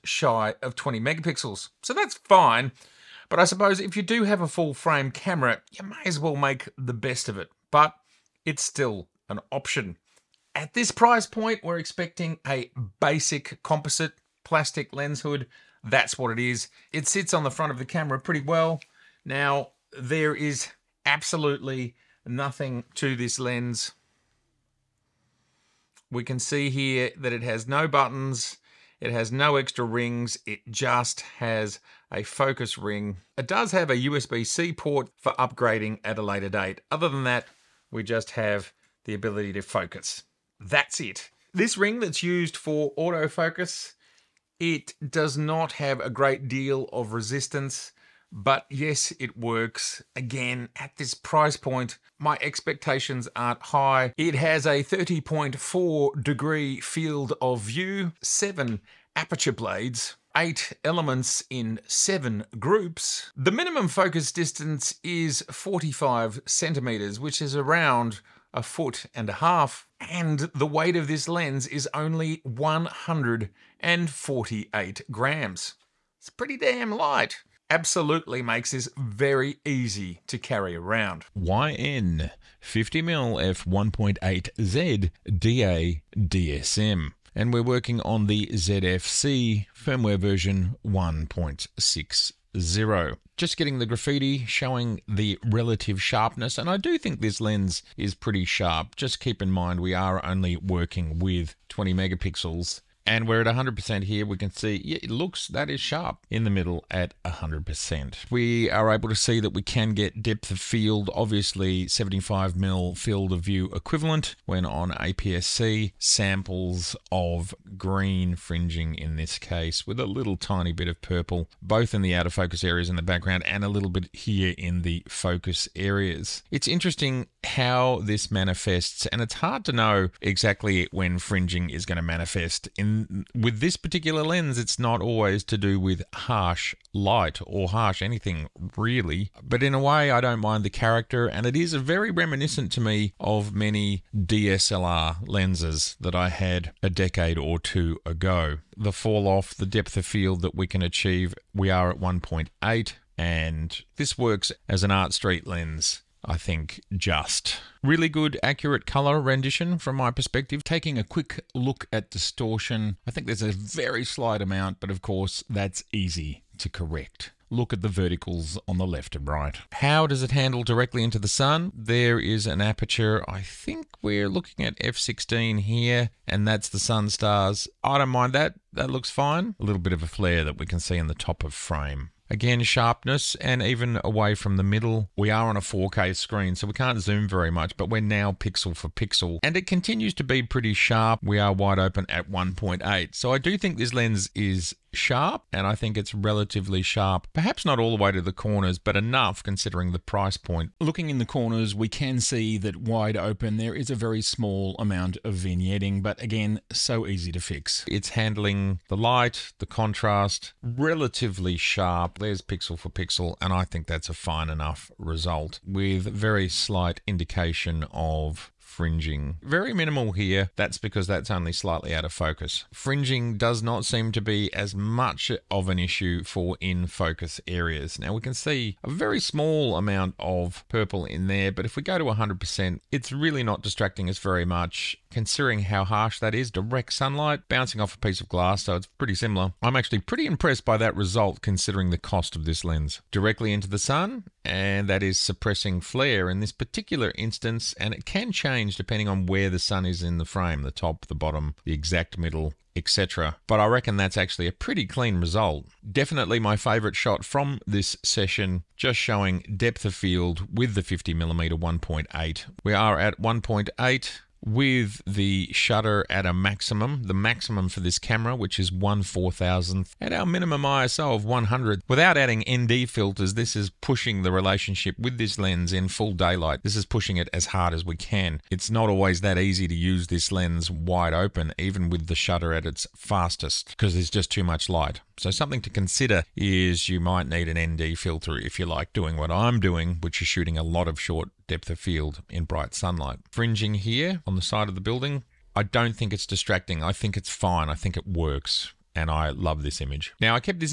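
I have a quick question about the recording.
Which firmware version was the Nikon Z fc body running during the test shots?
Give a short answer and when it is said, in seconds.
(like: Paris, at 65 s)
1.60, at 90 s.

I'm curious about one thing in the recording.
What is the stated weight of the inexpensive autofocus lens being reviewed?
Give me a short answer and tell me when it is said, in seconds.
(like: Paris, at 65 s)
148 grams, at 72 s.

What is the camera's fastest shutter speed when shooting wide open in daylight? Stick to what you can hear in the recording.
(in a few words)
1/4000th.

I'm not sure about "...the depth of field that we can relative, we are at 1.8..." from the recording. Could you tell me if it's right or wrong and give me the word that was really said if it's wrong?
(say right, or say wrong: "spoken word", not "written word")
wrong: "achieve", not "relative".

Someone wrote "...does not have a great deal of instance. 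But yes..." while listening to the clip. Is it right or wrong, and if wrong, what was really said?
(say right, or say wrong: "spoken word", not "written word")
wrong: "resistance", not "instance".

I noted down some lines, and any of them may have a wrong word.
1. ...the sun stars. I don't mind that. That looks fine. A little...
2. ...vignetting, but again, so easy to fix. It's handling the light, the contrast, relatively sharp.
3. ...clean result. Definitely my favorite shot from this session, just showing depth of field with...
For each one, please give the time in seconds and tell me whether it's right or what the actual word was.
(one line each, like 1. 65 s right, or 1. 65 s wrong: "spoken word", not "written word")
1. 176 s right
2. 205 s right
3. 254 s right.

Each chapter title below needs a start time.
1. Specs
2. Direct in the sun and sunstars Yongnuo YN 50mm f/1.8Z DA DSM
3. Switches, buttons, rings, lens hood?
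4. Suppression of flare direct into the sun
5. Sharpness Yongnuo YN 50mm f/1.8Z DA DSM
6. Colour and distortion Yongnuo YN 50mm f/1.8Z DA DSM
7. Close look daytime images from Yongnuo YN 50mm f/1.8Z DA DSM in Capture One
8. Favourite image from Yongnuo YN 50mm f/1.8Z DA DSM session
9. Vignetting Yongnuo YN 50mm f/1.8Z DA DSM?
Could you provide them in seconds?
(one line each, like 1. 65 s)
1. 55 s
2. 170 s
3. 12 s
4. 238 s
5. 96 s
6. 158 s
7. 80 s
8. 258 s
9. 198 s.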